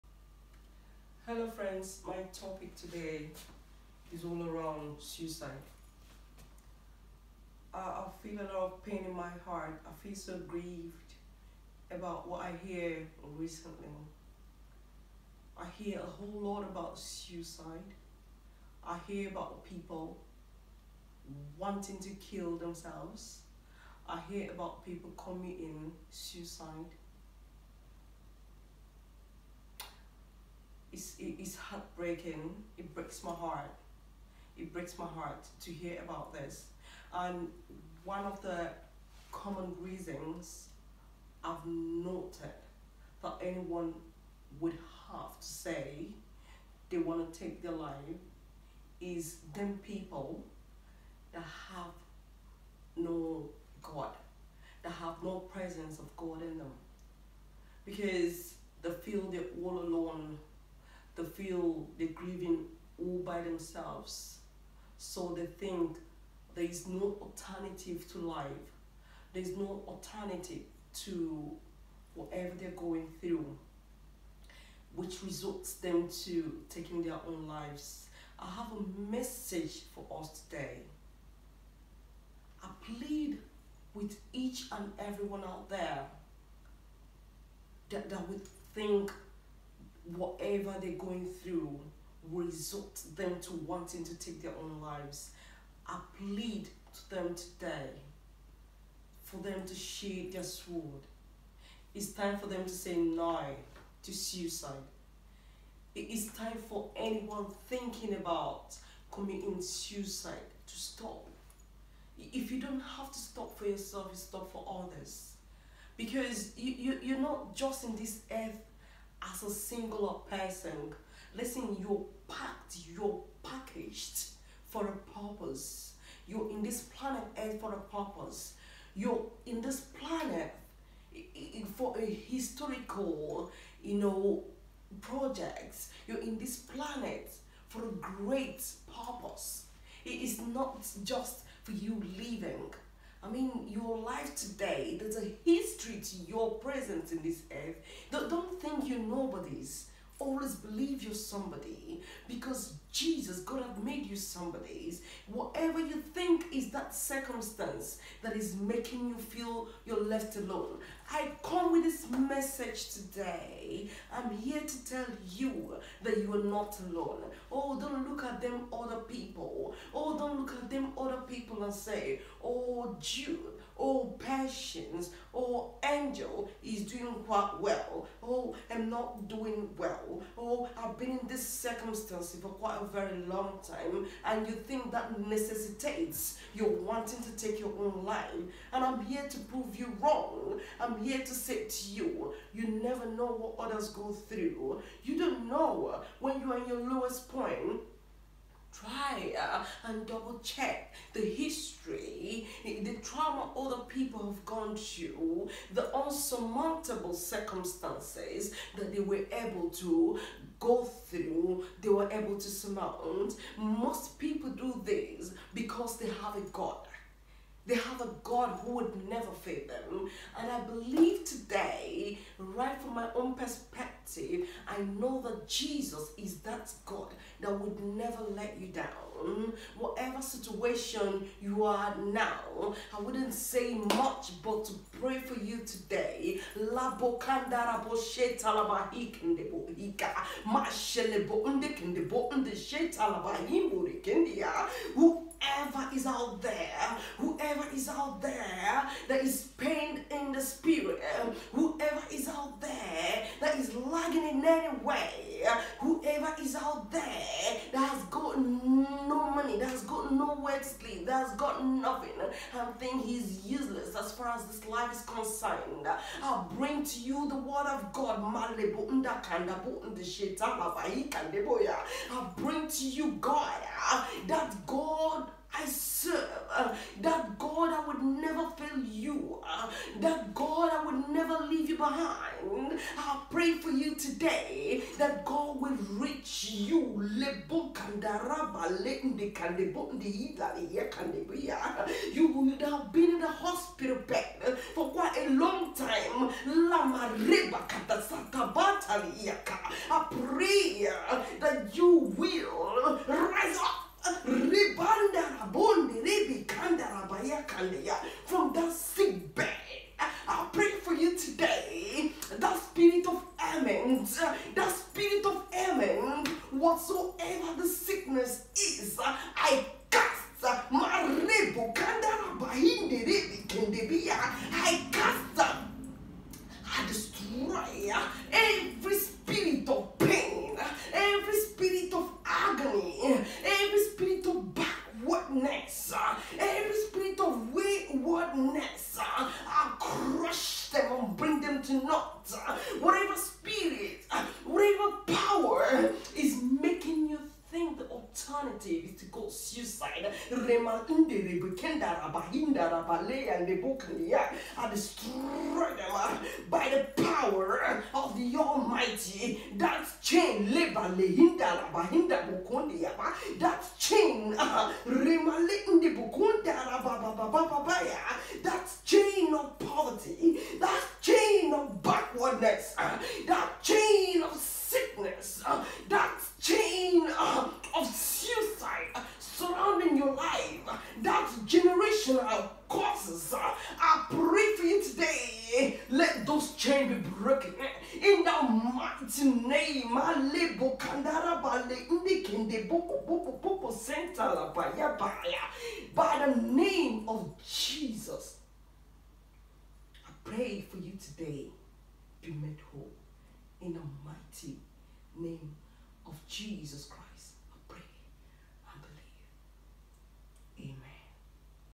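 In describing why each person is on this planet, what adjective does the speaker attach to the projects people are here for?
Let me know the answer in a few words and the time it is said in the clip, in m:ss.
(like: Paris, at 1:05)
Historical, at 2:12.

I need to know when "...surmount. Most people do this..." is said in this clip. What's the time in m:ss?
3:32.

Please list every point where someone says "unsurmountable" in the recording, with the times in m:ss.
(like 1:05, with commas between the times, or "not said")
3:25.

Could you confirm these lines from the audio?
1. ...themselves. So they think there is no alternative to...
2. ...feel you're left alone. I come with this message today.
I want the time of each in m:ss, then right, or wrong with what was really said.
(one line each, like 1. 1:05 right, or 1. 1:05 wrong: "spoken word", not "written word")
1. 1:03 right
2. 2:39 right.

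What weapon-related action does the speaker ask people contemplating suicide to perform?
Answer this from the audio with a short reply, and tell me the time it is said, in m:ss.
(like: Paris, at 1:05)
Sheathe their sword, at 1:39.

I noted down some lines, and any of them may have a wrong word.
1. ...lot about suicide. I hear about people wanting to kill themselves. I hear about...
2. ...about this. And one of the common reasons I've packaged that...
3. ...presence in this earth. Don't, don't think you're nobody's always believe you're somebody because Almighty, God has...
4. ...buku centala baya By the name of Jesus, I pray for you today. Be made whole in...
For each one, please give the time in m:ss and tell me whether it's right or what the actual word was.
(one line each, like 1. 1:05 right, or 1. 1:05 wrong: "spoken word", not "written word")
1. 0:16 right
2. 0:36 wrong: "noted", not "packaged"
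3. 2:26 wrong: "Jesus", not "Almighty"
4. 6:33 right.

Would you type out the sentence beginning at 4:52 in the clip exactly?
You would have been in the hospital bed for quite a long time.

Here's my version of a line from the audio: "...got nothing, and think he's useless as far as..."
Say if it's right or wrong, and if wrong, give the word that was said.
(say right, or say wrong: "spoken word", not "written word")
right.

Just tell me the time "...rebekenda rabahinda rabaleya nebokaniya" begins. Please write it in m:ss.
5:51.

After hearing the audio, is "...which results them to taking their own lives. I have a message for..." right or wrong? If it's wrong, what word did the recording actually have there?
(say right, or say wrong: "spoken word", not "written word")
right.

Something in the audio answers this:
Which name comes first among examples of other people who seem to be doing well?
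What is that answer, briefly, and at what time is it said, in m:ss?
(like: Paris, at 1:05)
Jude, at 2:52.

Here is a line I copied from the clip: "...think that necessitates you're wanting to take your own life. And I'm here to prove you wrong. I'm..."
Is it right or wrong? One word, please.
right.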